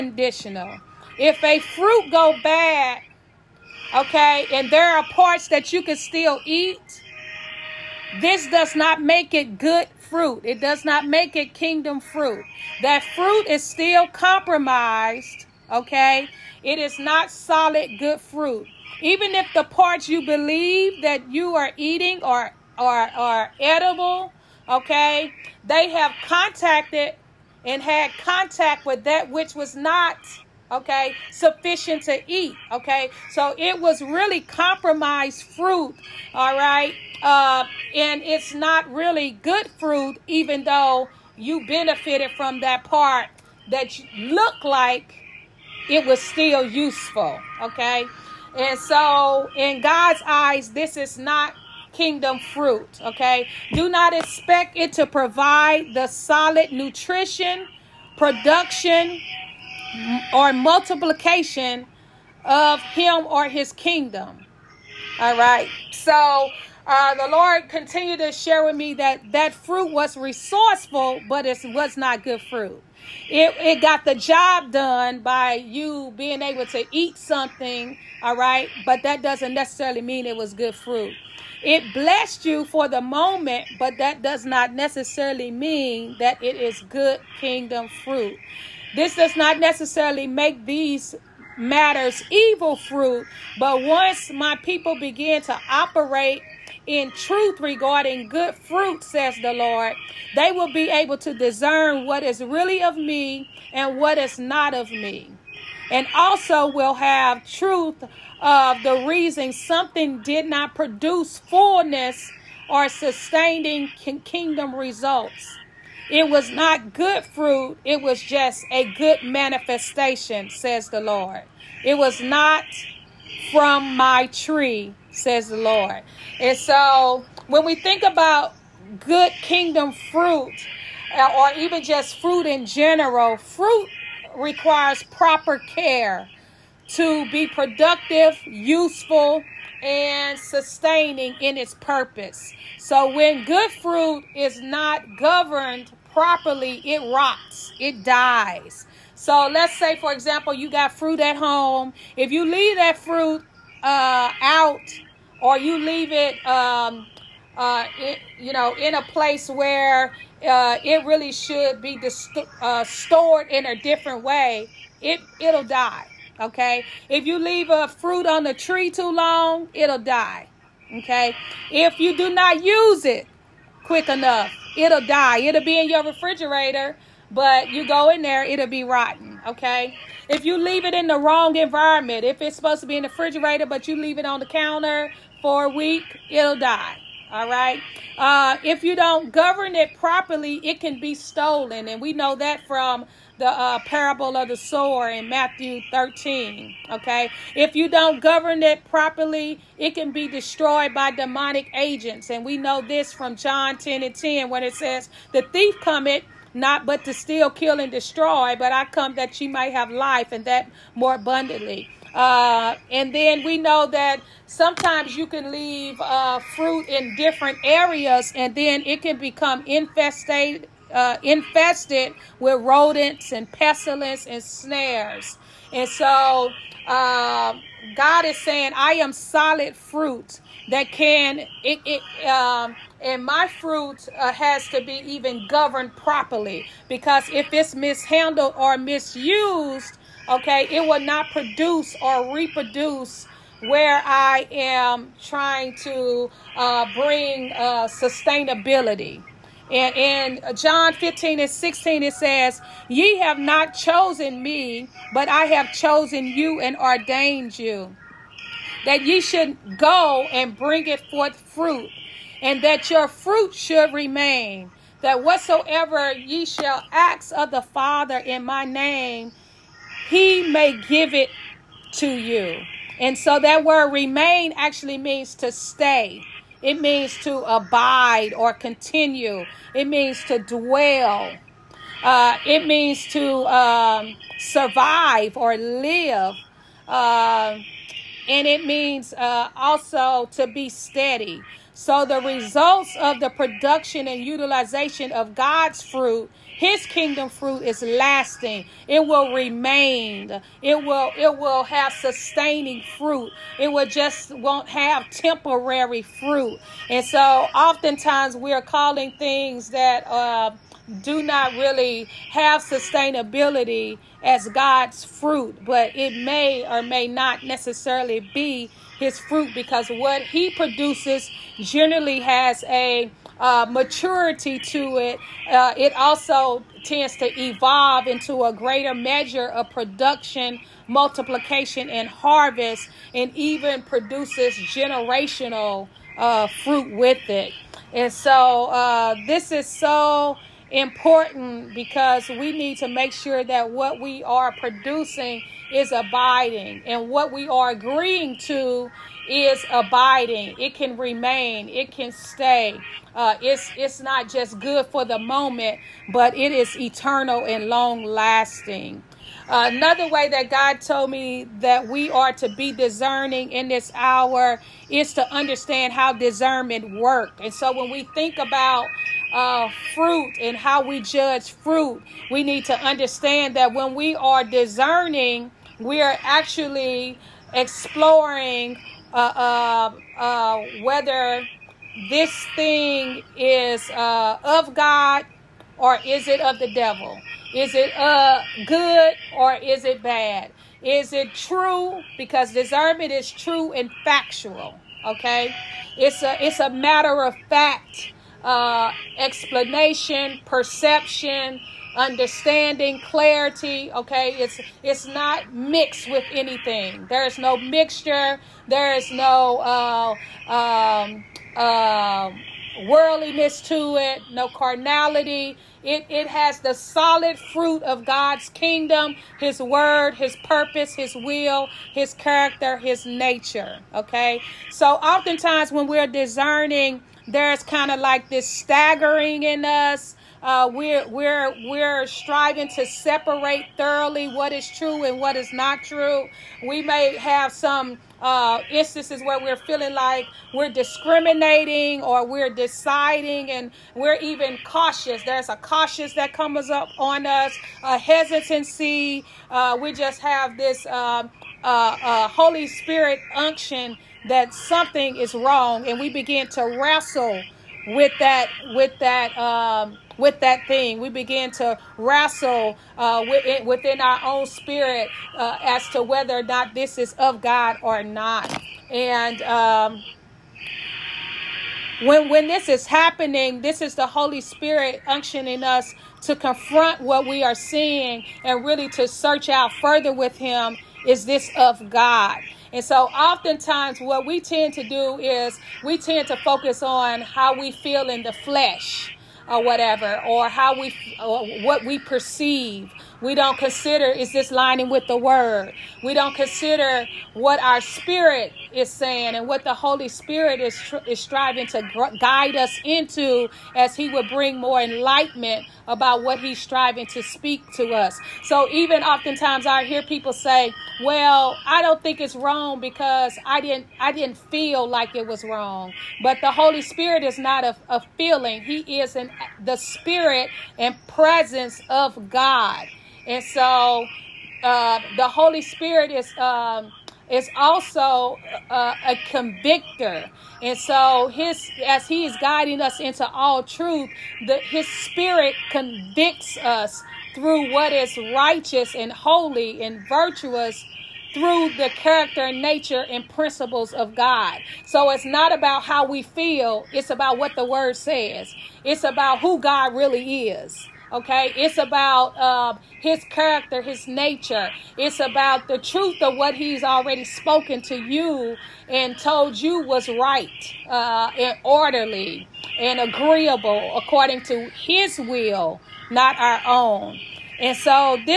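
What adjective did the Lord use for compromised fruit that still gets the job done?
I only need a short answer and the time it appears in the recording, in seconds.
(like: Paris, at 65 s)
resourceful, at 70 s.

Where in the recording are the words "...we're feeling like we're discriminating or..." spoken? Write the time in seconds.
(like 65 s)
439 s.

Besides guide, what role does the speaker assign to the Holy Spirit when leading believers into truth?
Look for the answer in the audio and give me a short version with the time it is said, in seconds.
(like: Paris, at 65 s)
convictor, at 529 s.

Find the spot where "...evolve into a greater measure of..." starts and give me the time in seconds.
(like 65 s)
327 s.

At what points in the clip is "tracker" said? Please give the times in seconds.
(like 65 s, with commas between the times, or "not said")
not said.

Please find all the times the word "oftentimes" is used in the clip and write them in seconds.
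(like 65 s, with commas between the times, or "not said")
307 s, 424 s, 483 s, 509 s.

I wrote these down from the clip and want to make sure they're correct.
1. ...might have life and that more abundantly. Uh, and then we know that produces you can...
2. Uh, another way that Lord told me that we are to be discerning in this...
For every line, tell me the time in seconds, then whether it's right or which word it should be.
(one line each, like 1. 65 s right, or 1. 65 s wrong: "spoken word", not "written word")
1. 209 s wrong: "sometimes", not "produces"
2. 359 s wrong: "God", not "Lord".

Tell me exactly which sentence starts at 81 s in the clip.
It blessed you for the moment, but that does not necessarily mean that it is good kingdom fruit.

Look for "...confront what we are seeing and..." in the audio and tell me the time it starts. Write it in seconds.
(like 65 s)
476 s.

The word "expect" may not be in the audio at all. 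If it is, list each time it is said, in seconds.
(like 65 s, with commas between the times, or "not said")
54 s.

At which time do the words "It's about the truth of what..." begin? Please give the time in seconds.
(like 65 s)
554 s.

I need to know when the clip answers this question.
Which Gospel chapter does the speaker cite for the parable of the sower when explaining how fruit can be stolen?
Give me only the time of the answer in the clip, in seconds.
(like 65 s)
195 s.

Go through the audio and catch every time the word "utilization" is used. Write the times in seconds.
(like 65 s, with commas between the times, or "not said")
294 s.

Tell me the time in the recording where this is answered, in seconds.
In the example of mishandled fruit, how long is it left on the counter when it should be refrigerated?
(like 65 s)
185 s.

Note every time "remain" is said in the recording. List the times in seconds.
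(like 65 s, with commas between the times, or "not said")
263 s, 273 s, 299 s, 350 s.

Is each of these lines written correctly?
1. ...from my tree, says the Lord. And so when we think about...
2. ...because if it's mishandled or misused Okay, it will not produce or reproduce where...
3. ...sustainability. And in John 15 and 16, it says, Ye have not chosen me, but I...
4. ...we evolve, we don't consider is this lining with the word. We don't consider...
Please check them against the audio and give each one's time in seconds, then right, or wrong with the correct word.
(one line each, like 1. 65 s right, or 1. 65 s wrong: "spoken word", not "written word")
1. 123 s right
2. 236 s right
3. 247 s right
4. 491 s wrong: "perceive", not "evolve".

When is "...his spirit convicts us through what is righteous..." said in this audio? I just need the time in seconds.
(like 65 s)
534 s.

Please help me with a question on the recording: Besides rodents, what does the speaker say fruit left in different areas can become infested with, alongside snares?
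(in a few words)
pestilence.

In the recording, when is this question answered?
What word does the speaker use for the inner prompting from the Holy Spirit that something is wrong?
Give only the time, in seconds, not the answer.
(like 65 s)
453 s.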